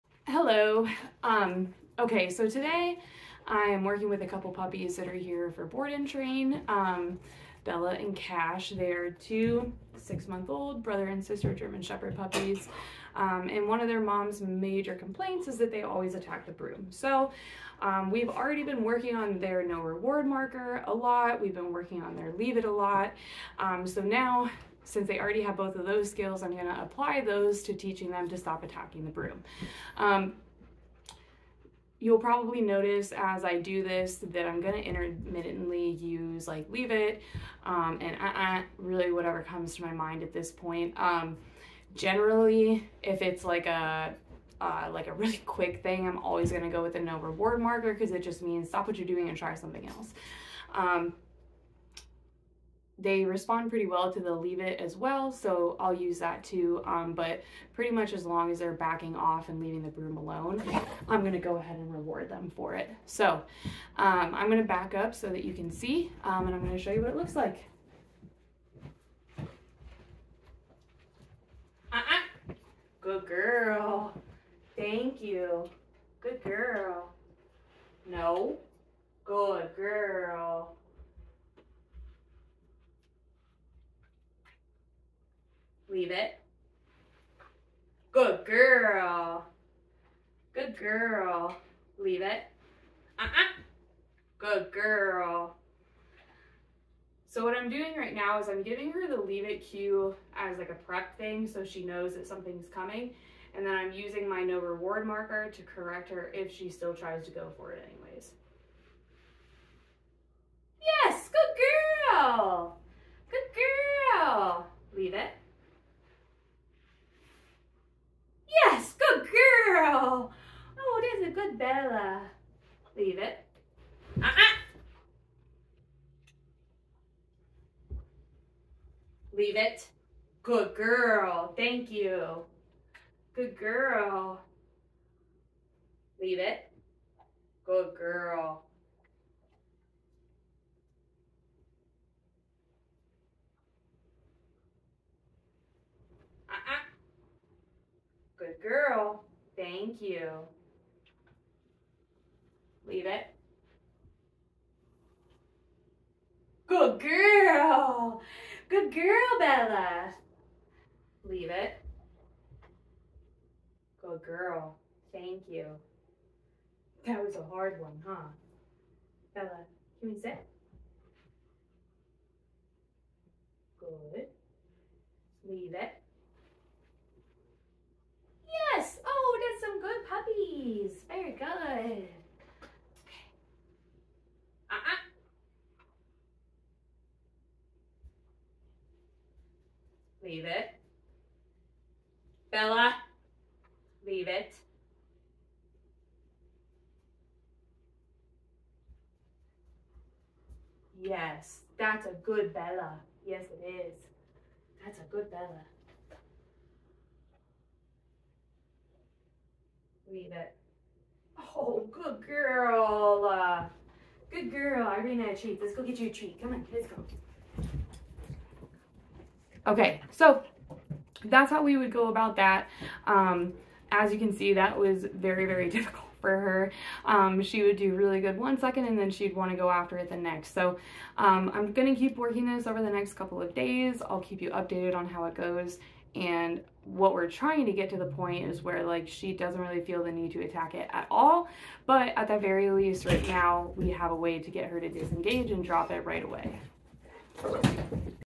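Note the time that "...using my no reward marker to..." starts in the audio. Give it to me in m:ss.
1:43.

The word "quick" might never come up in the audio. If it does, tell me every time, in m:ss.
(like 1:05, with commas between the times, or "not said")
0:45.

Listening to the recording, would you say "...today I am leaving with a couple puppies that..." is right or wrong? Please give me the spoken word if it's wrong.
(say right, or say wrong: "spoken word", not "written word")
wrong: "working", not "leaving".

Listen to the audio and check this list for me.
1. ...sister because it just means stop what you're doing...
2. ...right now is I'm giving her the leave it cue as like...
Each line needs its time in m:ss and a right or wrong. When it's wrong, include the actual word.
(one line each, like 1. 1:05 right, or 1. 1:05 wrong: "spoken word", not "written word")
1. 0:47 wrong: "marker", not "sister"
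2. 1:37 right.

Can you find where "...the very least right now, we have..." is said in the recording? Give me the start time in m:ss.
4:02.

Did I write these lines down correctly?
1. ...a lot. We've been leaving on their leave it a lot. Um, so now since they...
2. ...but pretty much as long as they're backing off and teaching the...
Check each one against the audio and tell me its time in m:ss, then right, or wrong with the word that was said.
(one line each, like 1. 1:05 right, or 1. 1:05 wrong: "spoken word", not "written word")
1. 0:20 wrong: "working", not "leaving"
2. 0:57 wrong: "leaving", not "teaching".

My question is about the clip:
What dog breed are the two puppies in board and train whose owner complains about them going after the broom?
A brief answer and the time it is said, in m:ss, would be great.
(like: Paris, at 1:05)
German Shepherd, at 0:11.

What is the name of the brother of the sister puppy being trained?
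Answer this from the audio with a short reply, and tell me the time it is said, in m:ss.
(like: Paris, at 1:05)
Cash, at 0:08.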